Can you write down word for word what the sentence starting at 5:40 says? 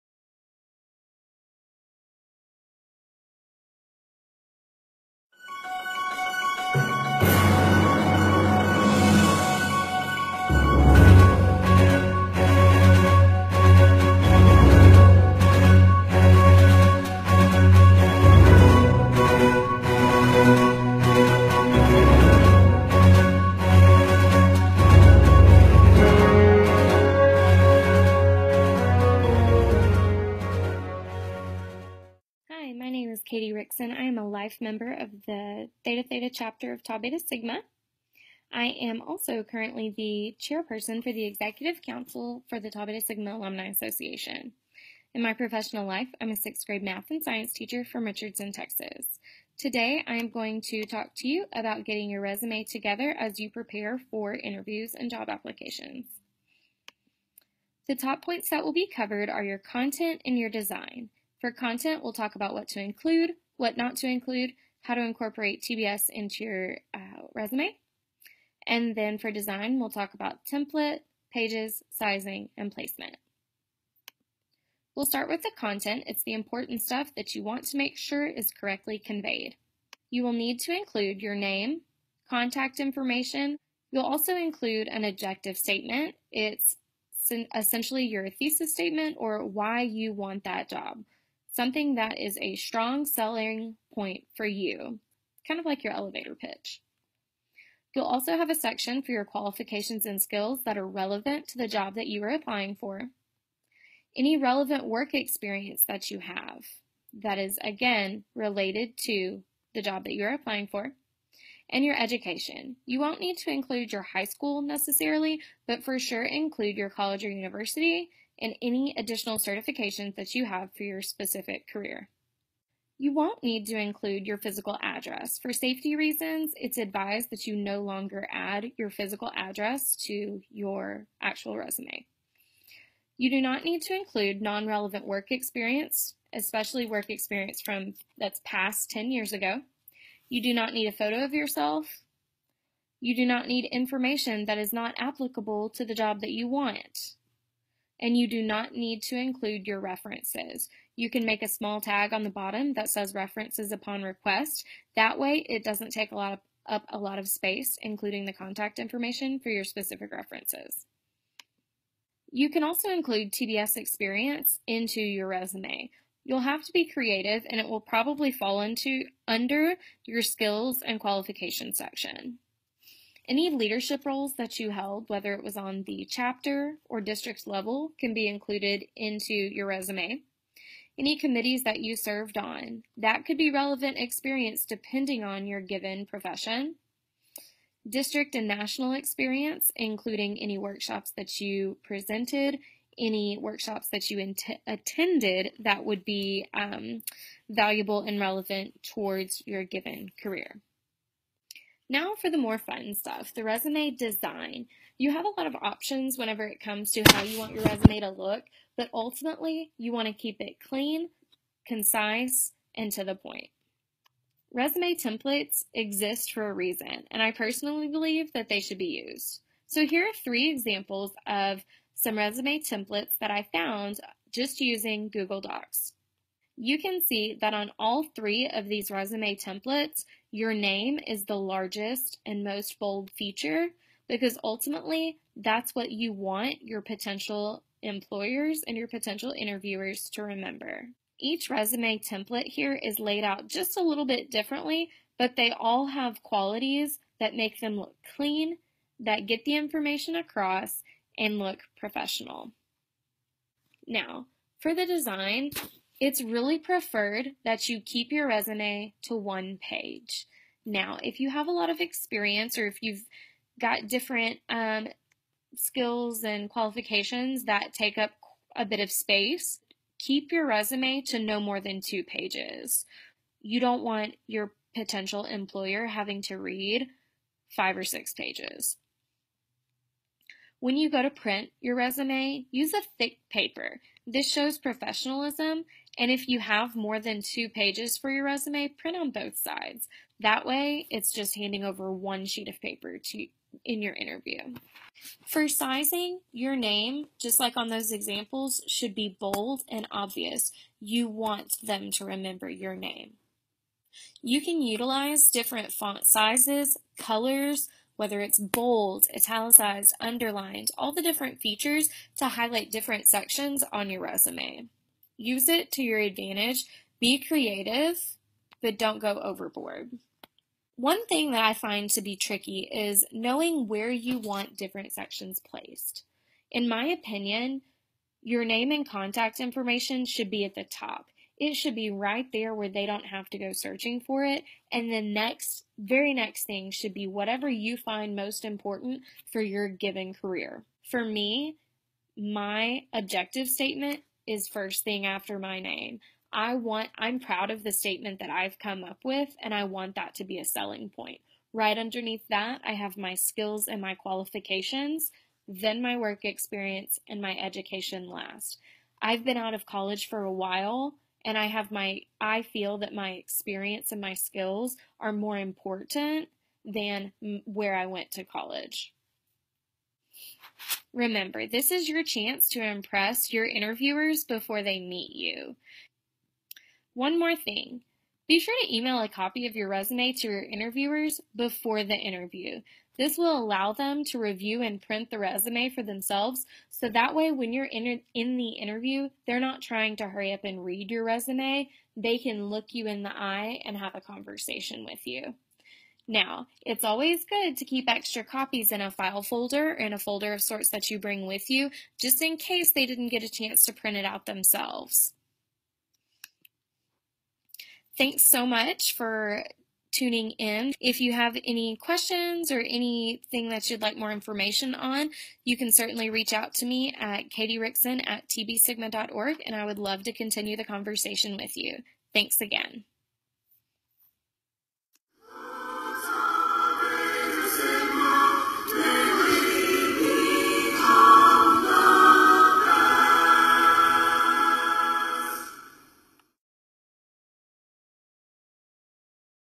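For me, my objective statement is first thing after my name.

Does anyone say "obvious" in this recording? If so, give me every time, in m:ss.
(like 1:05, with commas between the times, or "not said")
4:59.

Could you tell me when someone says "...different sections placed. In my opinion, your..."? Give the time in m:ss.
5:24.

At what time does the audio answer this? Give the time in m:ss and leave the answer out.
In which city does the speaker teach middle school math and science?
0:48.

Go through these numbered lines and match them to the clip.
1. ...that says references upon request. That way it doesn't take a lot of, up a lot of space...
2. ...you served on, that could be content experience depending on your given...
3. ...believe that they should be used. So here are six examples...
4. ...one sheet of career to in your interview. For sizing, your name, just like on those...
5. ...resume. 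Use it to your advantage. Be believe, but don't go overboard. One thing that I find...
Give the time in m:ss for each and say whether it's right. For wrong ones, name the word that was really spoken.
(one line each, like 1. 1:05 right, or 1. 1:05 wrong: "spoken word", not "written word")
1. 2:32 right
2. 3:01 wrong: "relevant", not "content"
3. 3:37 wrong: "three", not "six"
4. 4:51 wrong: "paper", not "career"
5. 5:14 wrong: "creative", not "believe".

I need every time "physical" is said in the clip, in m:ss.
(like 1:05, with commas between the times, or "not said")
2:04, 2:08.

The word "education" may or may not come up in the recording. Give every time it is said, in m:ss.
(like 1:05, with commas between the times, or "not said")
1:51, 5:57.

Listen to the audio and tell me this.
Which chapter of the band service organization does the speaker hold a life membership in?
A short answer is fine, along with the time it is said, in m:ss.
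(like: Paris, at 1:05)
Theta Theta, at 0:35.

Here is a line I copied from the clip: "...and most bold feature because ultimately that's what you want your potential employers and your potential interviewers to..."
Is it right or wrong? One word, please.
right.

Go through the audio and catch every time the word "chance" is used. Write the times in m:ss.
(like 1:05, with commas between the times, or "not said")
6:12, 6:43.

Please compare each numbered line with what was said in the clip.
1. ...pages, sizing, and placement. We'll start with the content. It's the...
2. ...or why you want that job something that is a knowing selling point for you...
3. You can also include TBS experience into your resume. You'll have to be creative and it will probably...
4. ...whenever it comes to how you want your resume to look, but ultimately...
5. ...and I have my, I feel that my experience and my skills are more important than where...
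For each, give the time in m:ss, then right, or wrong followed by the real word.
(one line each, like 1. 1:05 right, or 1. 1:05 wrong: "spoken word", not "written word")
1. 1:11 right
2. 1:29 wrong: "strong", not "knowing"
3. 2:42 right
4. 3:26 right
5. 6:01 right.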